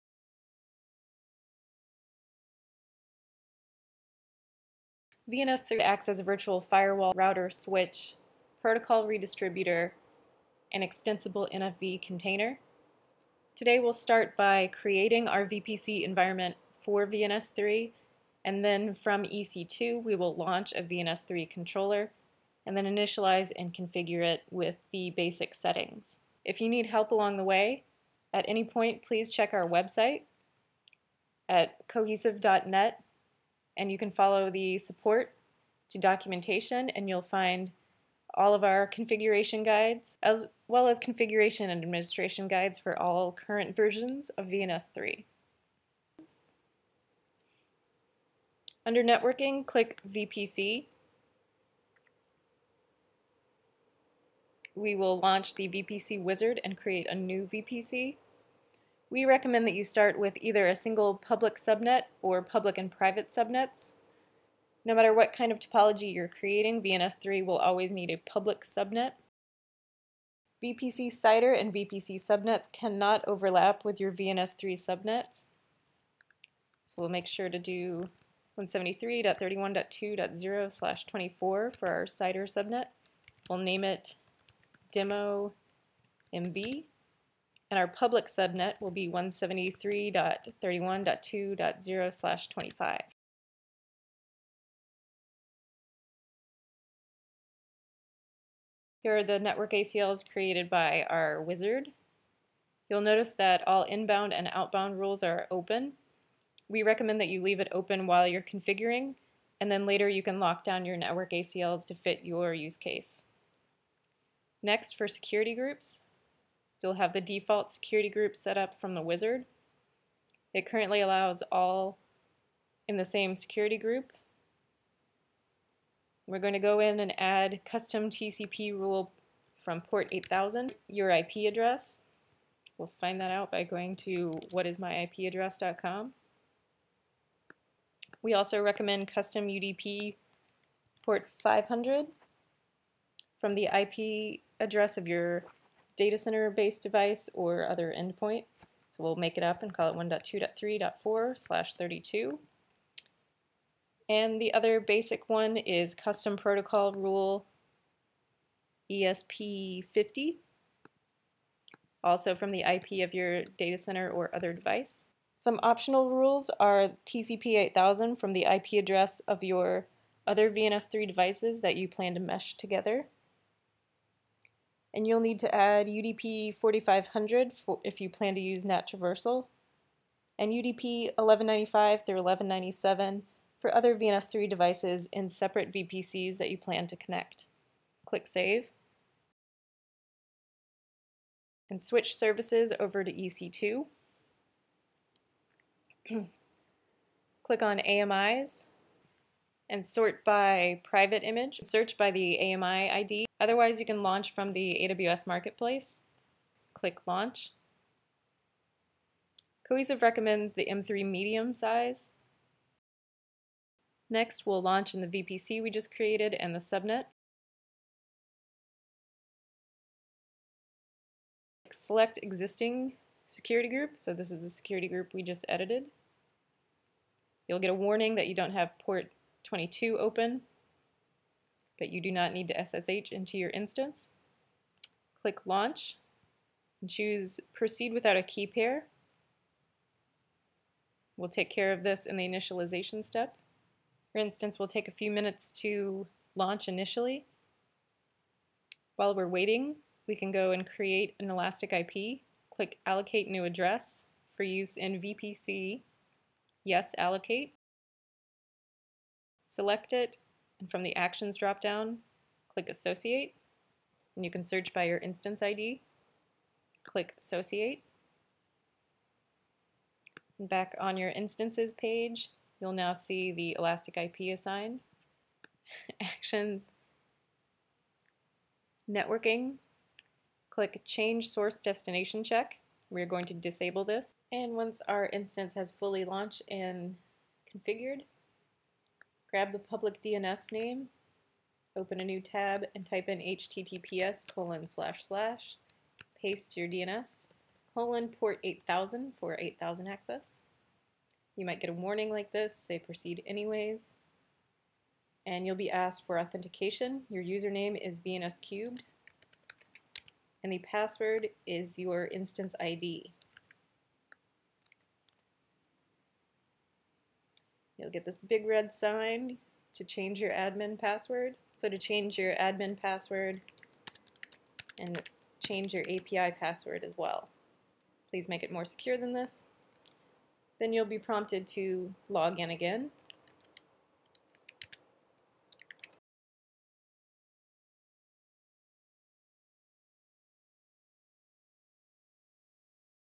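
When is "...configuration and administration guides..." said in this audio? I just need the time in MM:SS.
00:40.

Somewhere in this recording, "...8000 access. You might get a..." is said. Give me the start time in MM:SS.
04:59.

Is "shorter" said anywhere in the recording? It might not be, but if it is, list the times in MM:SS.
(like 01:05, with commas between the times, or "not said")
not said.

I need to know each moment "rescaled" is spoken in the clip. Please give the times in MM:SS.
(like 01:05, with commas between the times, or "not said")
not said.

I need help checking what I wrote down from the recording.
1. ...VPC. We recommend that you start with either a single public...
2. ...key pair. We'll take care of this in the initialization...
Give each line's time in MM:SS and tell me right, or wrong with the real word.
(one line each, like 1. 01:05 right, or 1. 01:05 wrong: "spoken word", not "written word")
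1. 00:57 right
2. 03:58 right.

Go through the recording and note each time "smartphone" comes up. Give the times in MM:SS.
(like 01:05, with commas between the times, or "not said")
not said.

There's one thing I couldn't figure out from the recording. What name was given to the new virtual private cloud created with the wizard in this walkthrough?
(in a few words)
demo MB.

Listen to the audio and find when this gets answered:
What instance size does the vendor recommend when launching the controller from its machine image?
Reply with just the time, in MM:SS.
03:30.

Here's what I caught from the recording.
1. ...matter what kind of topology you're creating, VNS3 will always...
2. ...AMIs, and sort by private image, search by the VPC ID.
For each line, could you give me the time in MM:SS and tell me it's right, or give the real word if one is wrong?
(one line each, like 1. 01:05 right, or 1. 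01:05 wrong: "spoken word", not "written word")
1. 01:04 right
2. 03:17 wrong: "AMI", not "VPC".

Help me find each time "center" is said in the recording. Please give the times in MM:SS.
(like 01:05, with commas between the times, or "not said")
02:26, 02:43.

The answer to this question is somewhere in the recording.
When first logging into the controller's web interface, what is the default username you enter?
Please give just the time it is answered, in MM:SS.
05:08.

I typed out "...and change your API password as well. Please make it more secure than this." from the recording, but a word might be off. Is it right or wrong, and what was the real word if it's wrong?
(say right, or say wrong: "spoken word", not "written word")
right.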